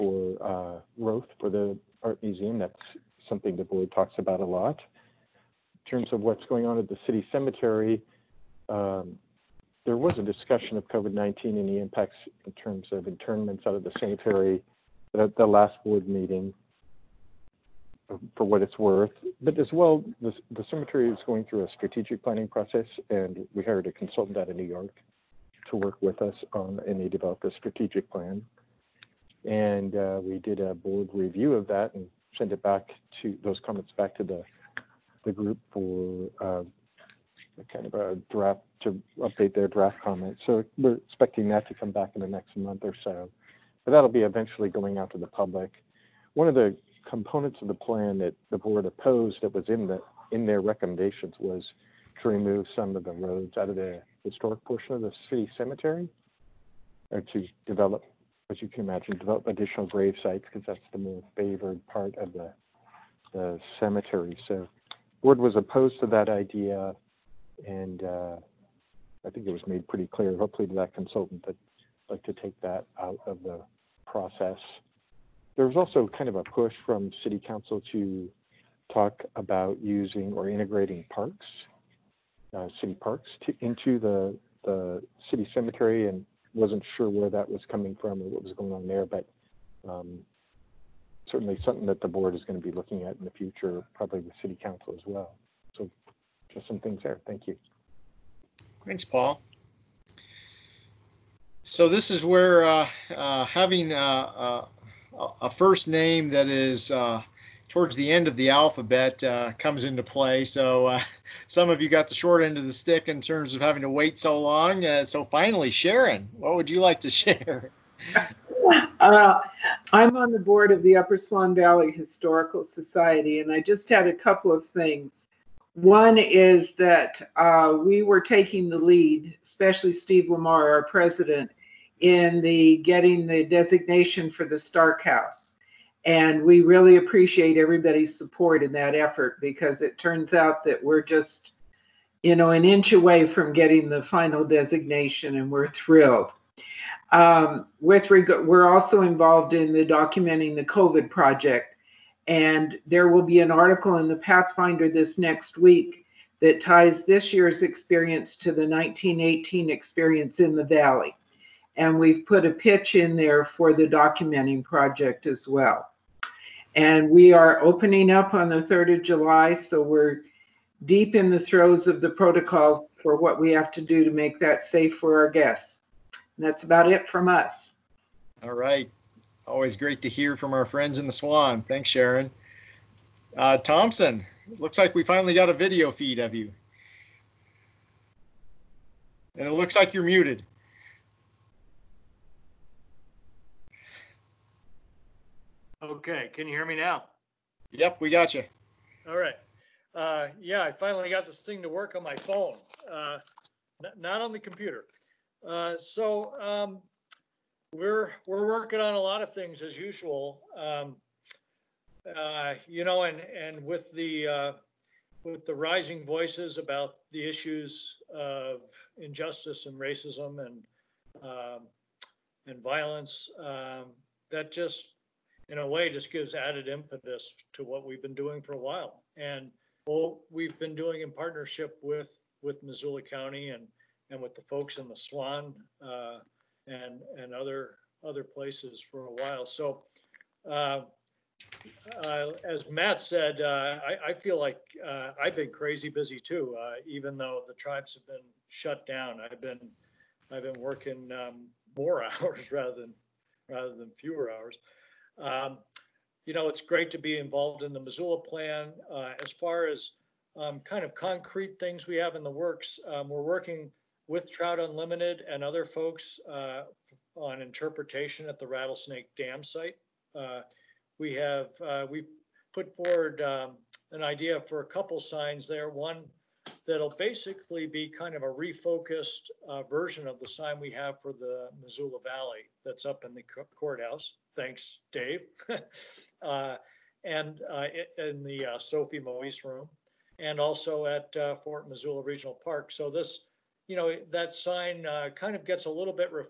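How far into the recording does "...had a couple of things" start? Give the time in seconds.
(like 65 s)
123 s.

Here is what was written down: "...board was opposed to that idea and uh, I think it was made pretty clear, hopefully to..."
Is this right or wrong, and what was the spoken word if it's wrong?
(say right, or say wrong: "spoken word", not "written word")
right.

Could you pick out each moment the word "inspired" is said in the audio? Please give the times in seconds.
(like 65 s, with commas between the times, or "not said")
not said.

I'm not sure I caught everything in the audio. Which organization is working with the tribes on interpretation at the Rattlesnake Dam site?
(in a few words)
Trout Unlimited.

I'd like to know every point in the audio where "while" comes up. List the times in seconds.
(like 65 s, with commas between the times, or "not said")
228 s, 239 s.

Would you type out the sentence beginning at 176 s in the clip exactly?
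And that's about it from us.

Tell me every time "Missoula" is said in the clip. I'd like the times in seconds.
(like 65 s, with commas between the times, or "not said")
232 s, 257 s, 281 s, 291 s.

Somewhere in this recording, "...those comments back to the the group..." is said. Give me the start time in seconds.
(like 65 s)
33 s.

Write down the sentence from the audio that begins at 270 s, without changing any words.
Uh, we have, uh, we put forward um, an idea for a couple signs there.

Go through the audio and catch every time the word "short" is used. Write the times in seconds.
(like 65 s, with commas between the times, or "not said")
112 s.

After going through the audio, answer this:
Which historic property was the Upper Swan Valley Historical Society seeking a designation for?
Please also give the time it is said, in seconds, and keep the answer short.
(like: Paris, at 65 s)
Stark House, at 134 s.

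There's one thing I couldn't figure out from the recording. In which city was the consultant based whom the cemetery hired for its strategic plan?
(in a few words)
New York.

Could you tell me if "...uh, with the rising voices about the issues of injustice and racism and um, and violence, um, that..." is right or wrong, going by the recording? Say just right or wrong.
right.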